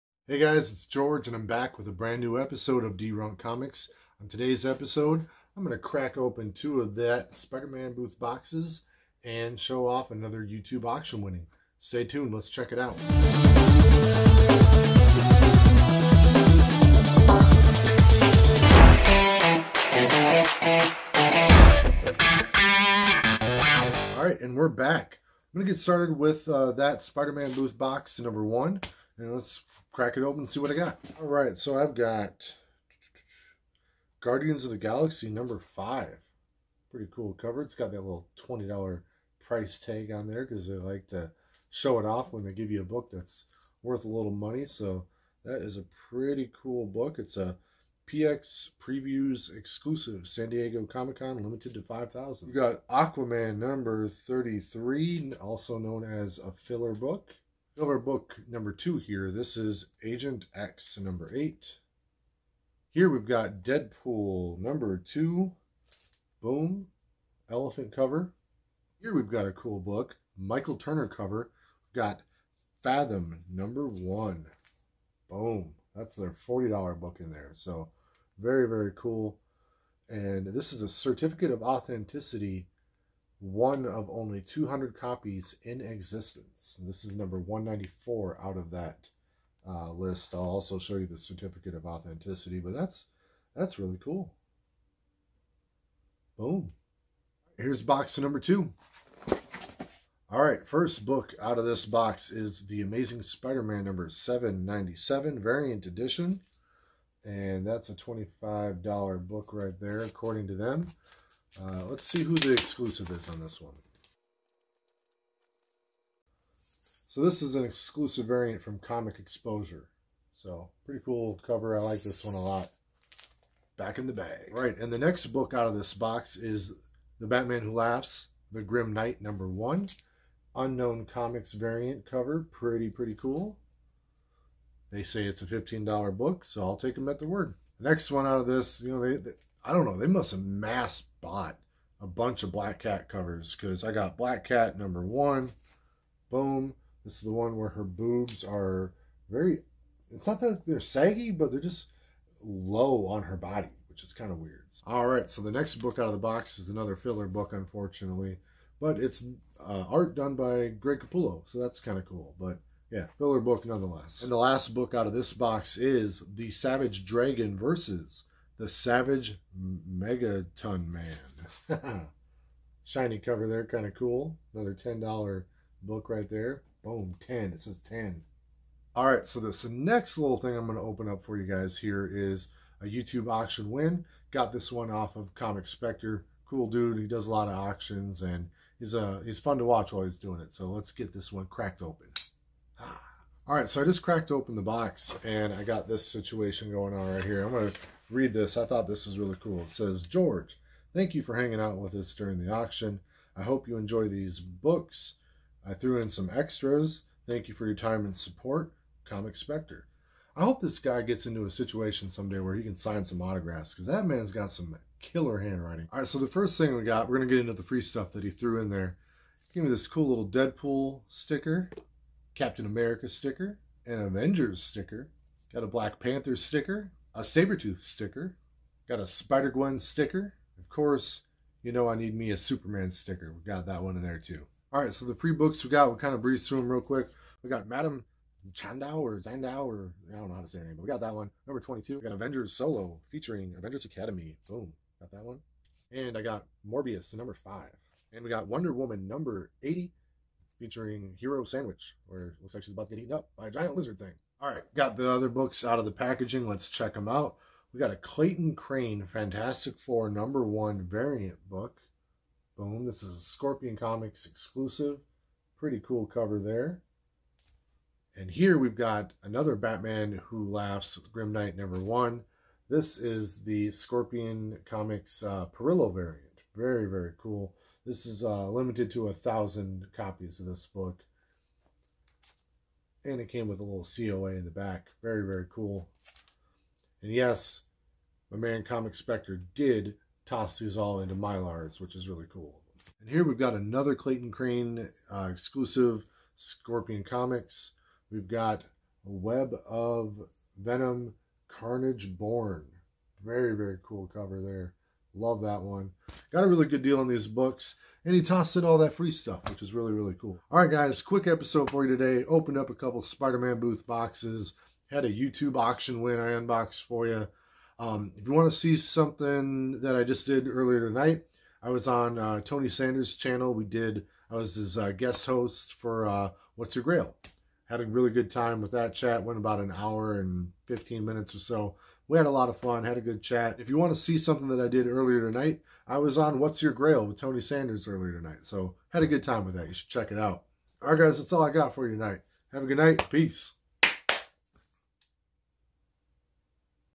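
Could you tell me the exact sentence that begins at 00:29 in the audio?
And let's crack it open and see what I got.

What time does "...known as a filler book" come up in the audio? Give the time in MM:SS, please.
00:55.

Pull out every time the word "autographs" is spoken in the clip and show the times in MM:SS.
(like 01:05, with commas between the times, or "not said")
03:33.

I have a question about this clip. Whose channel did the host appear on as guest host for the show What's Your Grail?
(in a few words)
Tony Sanders.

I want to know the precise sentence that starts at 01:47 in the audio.
And that's a $25 book right there, according to them.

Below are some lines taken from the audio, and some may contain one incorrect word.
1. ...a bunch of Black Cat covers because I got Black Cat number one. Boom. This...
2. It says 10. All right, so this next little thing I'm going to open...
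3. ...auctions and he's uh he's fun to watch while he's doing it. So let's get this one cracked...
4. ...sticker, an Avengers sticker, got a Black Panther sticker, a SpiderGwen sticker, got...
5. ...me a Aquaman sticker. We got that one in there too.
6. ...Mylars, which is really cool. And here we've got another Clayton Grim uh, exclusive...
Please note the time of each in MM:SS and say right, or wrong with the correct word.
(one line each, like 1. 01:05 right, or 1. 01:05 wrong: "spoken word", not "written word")
1. 02:22 right
2. 02:57 right
3. 03:07 right
4. 03:43 wrong: "Sabretooth", not "SpiderGwen"
5. 03:52 wrong: "Superman", not "Aquaman"
6. 04:51 wrong: "Crain", not "Grim".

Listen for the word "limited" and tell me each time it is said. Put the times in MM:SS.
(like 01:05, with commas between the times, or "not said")
00:51, 04:38.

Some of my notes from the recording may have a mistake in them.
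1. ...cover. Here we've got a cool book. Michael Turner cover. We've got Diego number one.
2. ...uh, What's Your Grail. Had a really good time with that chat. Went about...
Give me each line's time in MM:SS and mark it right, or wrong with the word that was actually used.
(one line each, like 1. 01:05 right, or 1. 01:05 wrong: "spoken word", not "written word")
1. 01:07 wrong: "Fathom", not "Diego"
2. 05:26 right.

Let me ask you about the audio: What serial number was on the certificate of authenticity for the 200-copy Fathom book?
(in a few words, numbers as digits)
194.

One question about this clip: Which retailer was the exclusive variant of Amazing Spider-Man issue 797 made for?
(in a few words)
Comic Exposure.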